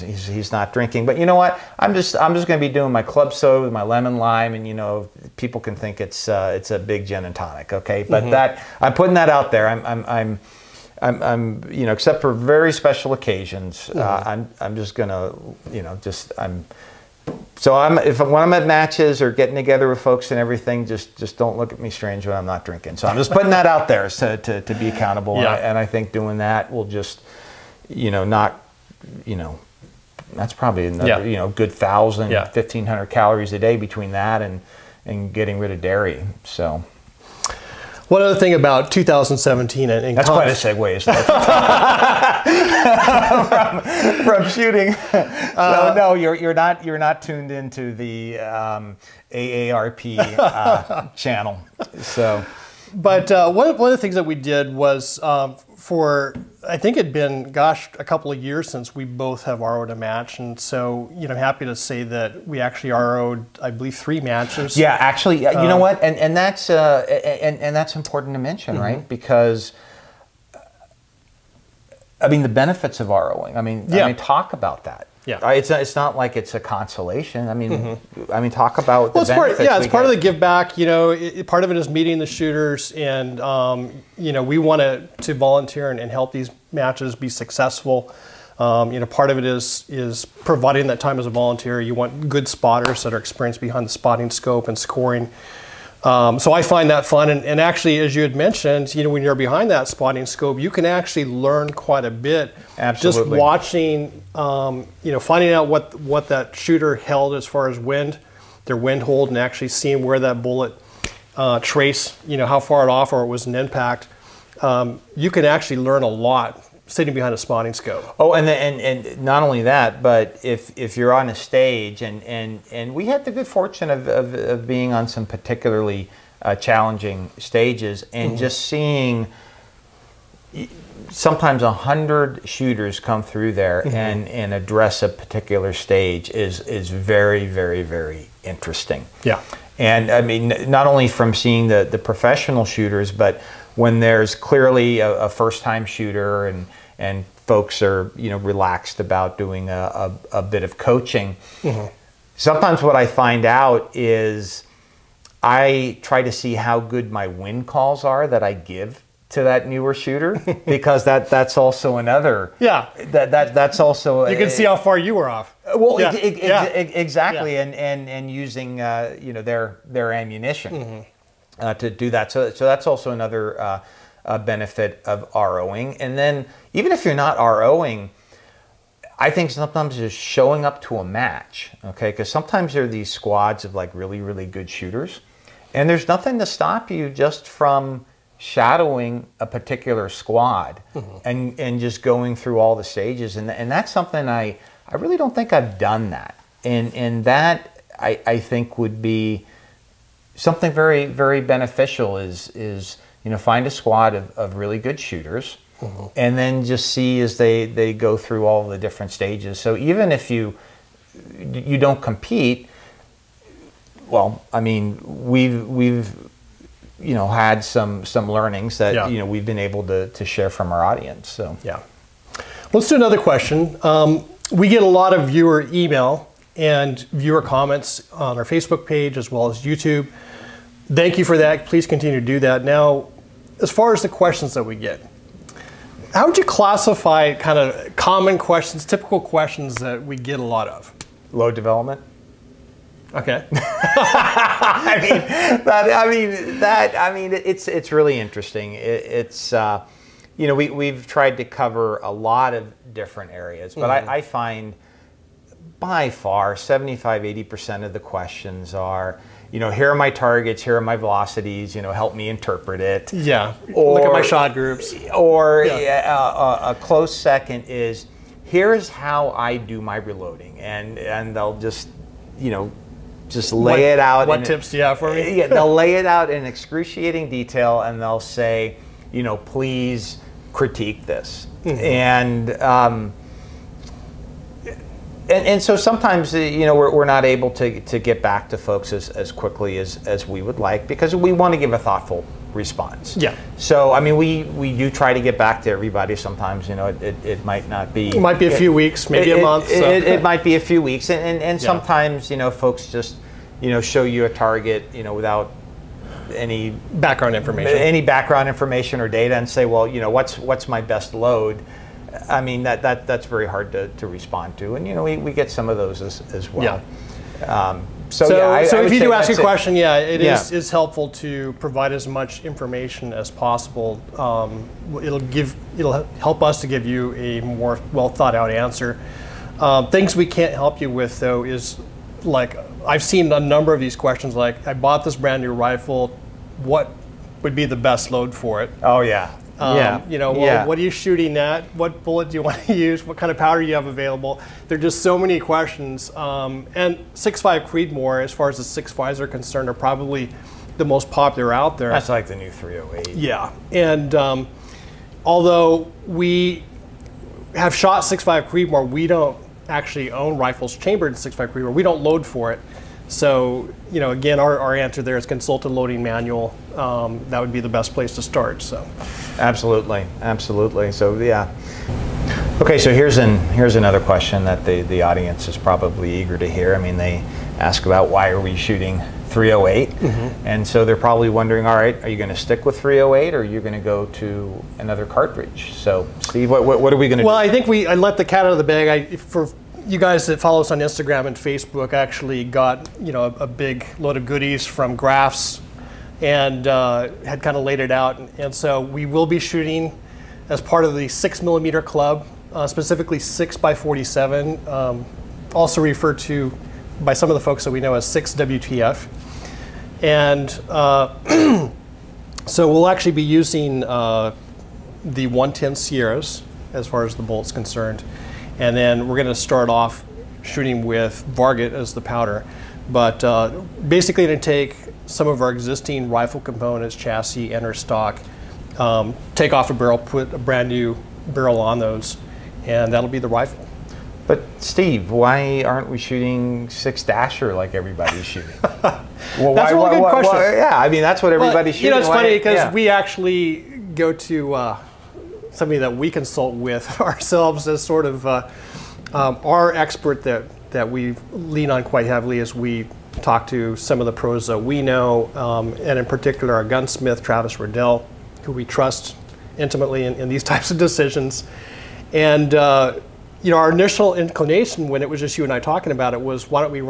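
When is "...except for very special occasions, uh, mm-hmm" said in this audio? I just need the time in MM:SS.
00:11.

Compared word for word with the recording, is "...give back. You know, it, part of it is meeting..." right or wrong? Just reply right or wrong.
right.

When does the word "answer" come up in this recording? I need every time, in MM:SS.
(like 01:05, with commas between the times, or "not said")
05:28, 06:04.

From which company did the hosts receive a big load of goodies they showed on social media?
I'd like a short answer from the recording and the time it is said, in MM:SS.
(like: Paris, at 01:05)
Graphs, at 06:34.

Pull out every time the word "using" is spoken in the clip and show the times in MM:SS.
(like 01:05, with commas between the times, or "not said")
02:48, 06:53.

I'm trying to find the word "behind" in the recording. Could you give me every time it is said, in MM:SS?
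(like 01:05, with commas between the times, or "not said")
01:33, 01:39, 01:57.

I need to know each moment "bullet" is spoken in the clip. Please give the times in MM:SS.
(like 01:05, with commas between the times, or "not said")
01:50, 05:42.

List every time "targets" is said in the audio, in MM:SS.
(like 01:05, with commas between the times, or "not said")
04:20, 05:04.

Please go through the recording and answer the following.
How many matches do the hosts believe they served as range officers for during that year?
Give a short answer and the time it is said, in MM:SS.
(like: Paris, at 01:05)
3, at 01:03.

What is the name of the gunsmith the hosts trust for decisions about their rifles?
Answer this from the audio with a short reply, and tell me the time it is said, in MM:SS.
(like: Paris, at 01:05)
Travis Riddell, at 07:37.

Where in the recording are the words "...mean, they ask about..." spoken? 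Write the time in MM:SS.
06:16.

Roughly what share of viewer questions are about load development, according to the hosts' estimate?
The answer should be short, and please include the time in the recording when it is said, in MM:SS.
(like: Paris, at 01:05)
75-80 percent, at 04:16.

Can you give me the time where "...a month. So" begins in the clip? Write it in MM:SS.
04:59.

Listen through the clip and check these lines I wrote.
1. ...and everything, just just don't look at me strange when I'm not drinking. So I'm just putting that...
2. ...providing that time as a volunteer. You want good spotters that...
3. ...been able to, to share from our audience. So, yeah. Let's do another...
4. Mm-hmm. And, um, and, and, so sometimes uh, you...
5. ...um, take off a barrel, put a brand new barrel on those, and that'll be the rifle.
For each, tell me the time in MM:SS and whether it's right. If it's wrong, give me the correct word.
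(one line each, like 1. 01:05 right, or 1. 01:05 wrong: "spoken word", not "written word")
1. 00:20 right
2. 01:30 right
3. 03:39 right
4. 04:41 right
5. 07:08 right.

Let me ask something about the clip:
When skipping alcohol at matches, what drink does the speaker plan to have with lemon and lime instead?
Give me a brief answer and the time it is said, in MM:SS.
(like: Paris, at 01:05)
club soda, at 00:03.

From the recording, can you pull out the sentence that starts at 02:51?
uh, to do that so so that's also another uh, uh, benefit of ROing.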